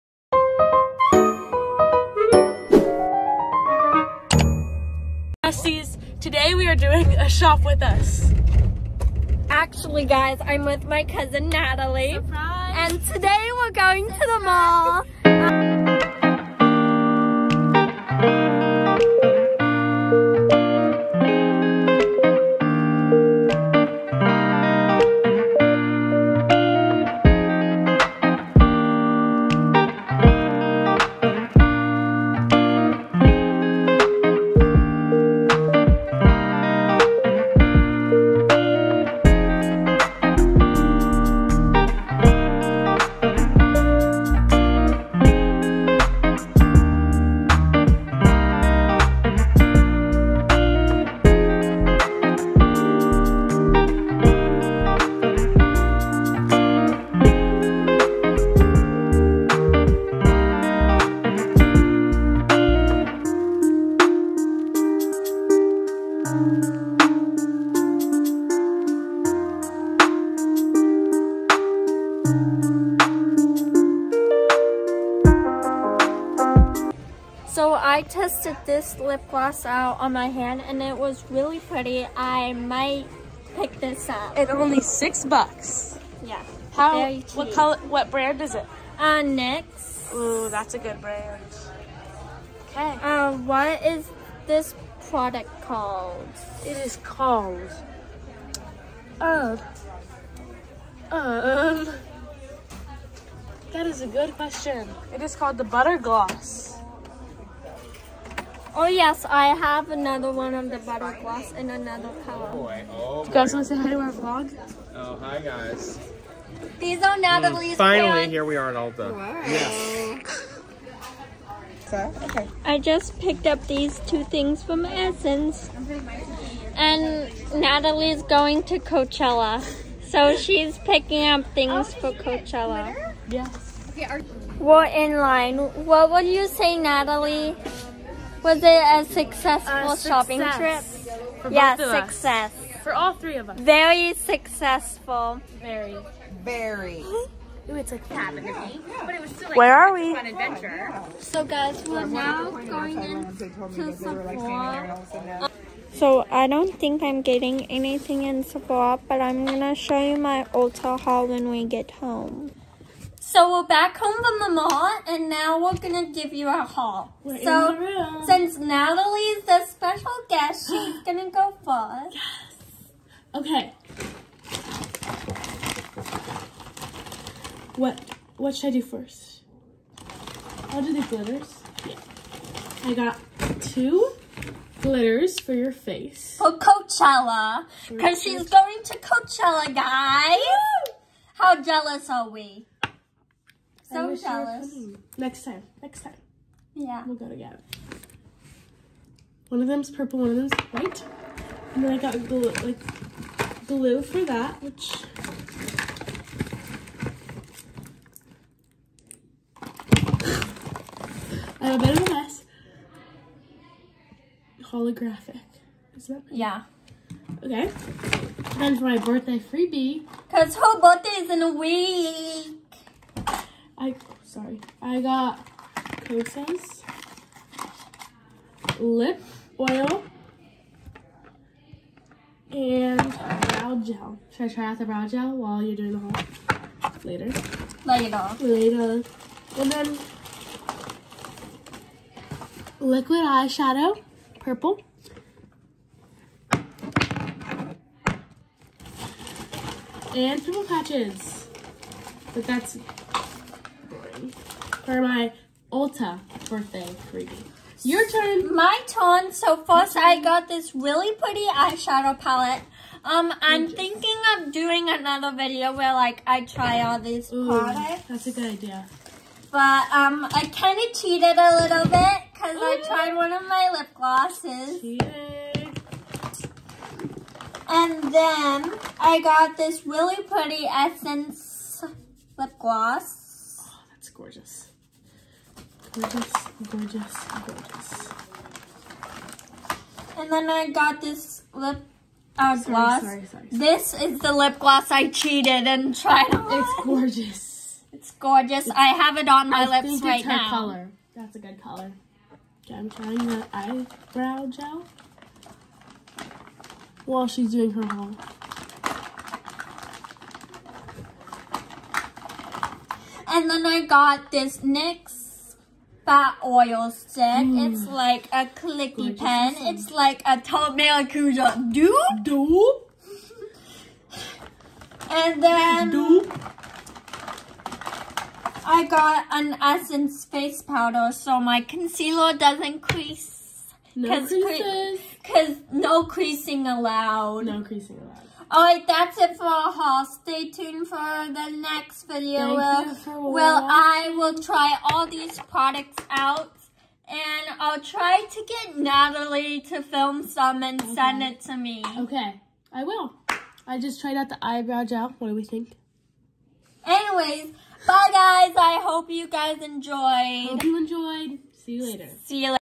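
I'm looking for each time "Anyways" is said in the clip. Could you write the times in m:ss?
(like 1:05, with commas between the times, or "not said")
5:56.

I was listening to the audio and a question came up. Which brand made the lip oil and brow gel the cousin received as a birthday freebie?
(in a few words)
Kosas.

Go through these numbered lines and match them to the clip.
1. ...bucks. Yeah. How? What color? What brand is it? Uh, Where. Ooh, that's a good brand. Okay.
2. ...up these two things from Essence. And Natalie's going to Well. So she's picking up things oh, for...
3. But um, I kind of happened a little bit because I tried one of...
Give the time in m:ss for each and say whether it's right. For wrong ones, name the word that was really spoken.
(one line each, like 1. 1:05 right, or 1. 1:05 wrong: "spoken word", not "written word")
1. 1:25 wrong: "NYX", not "Where"
2. 2:03 wrong: "Coachella", not "Well"
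3. 4:29 wrong: "cheated", not "happened".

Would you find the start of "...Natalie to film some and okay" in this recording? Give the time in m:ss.
5:48.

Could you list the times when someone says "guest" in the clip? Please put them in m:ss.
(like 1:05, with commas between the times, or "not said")
2:50.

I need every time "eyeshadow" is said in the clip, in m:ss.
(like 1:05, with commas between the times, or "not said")
4:03, 4:21.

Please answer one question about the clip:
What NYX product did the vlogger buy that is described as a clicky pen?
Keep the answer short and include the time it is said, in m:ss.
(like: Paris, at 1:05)
Fat oil stick, at 5:16.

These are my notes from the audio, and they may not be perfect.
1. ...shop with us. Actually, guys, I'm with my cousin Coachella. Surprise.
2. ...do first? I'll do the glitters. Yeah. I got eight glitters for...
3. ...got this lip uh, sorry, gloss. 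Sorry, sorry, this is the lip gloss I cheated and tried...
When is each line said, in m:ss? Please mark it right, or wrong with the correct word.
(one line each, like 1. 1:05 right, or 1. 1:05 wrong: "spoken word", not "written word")
1. 0:07 wrong: "Natalie", not "Coachella"
2. 2:58 wrong: "two", not "eight"
3. 4:50 right.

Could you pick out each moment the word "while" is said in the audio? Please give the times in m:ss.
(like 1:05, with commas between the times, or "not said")
3:55, 5:07.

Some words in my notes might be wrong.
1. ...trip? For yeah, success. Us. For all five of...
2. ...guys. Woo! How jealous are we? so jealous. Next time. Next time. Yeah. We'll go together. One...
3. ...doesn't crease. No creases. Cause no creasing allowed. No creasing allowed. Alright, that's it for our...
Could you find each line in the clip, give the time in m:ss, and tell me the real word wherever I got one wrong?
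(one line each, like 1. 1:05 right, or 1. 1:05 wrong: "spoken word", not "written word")
1. 2:20 wrong: "three", not "five"
2. 3:09 right
3. 5:32 right.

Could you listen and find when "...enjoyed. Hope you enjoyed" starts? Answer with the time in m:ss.
5:59.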